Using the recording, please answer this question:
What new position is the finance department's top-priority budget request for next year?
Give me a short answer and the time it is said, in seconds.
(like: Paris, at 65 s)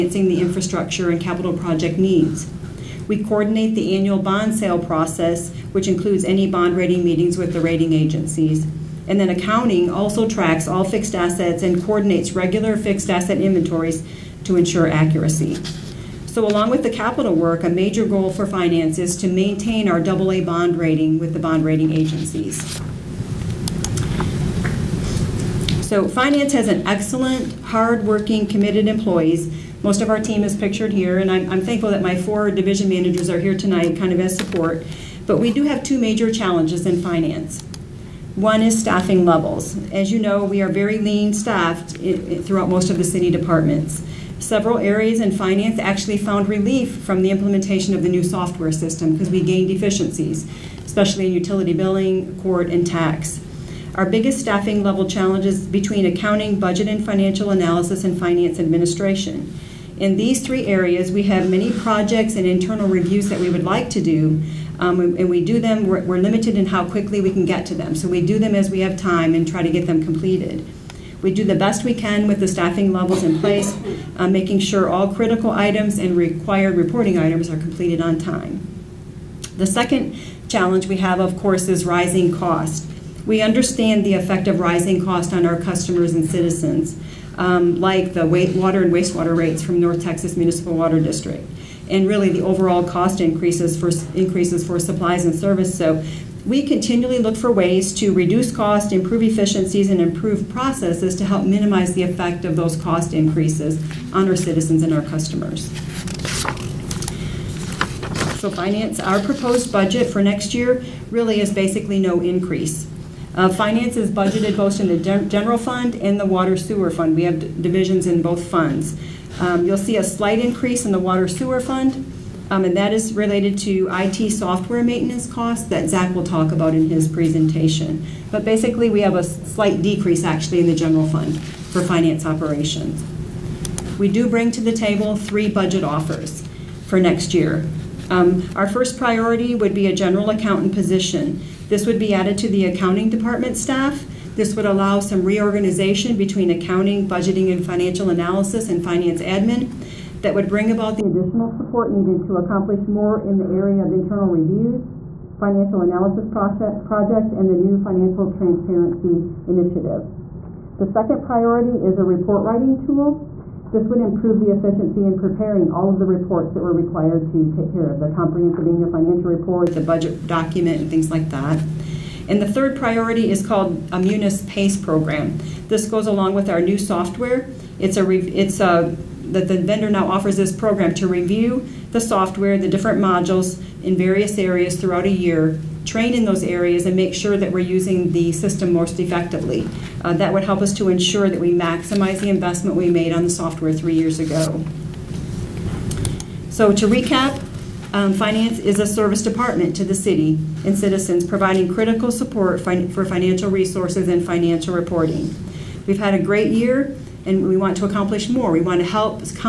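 General accountant, at 139 s.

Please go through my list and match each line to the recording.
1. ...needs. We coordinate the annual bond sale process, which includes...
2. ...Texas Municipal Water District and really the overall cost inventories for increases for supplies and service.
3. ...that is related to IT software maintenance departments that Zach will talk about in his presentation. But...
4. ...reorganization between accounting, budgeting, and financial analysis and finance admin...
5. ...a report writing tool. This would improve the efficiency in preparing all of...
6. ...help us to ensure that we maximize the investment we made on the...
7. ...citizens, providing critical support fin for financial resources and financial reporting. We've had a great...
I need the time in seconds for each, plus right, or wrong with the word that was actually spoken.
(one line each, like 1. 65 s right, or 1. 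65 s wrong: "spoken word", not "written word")
1. 1 s right
2. 90 s wrong: "increases", not "inventories"
3. 122 s wrong: "costs", not "departments"
4. 145 s right
5. 161 s right
6. 190 s right
7. 200 s right.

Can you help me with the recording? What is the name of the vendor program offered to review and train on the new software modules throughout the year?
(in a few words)
Munis PACE.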